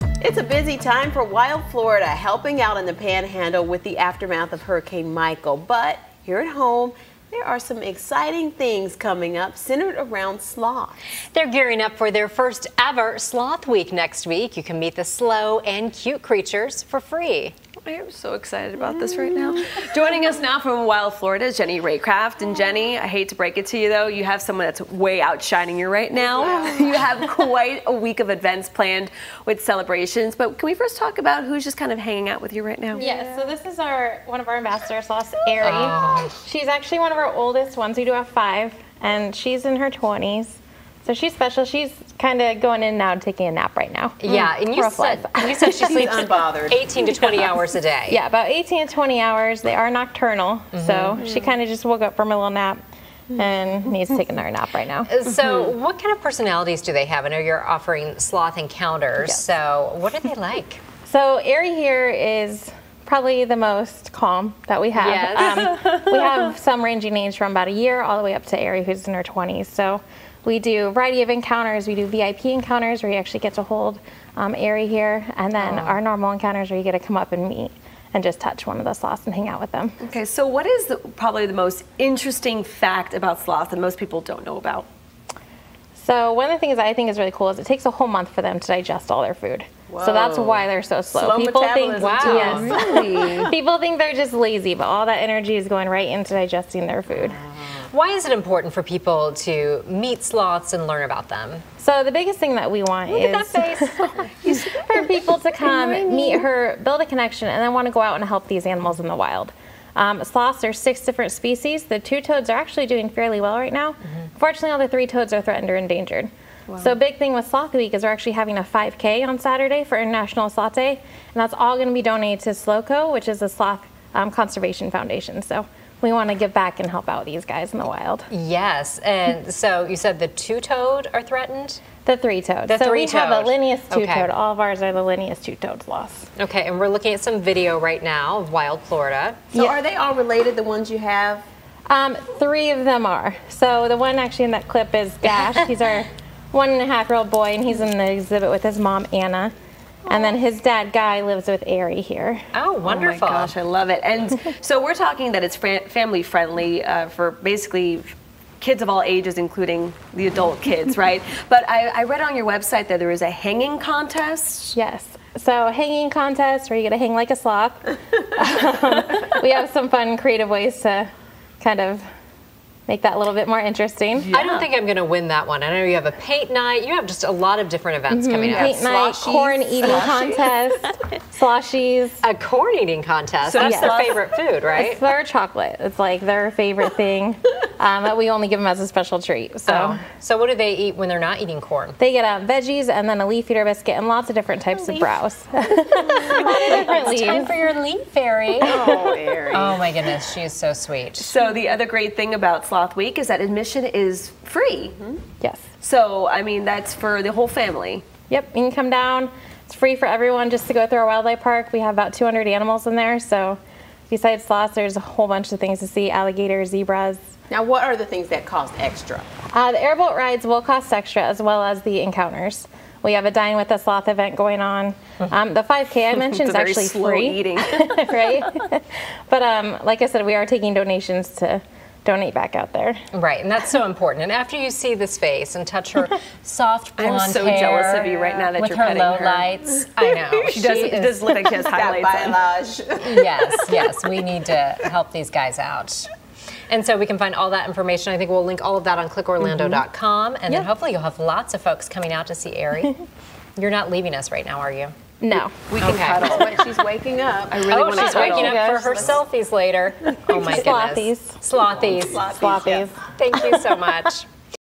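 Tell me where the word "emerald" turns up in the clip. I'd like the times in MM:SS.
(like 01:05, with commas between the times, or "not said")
not said.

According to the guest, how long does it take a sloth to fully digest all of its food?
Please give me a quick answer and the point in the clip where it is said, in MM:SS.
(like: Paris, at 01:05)
a whole month, at 01:27.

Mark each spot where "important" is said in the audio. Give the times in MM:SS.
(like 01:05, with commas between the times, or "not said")
01:38, 03:53.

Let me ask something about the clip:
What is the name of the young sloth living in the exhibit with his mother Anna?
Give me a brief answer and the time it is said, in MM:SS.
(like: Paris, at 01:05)
Dash, at 02:25.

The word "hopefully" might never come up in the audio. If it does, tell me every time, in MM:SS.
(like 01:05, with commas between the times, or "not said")
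04:10.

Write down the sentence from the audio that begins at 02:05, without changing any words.
So we want to give back and help out these guys in the wild.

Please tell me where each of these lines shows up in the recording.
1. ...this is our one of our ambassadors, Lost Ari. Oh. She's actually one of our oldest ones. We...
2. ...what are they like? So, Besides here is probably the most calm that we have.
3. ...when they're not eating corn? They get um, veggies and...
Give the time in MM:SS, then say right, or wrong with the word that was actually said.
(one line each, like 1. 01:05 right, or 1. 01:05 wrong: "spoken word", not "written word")
1. 00:33 right
2. 01:00 wrong: "Ari", not "Besides"
3. 03:10 right.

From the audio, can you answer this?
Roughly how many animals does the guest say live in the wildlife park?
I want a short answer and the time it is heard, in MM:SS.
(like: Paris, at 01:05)
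200, at 03:32.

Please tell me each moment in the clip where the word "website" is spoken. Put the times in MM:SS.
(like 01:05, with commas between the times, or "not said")
02:42.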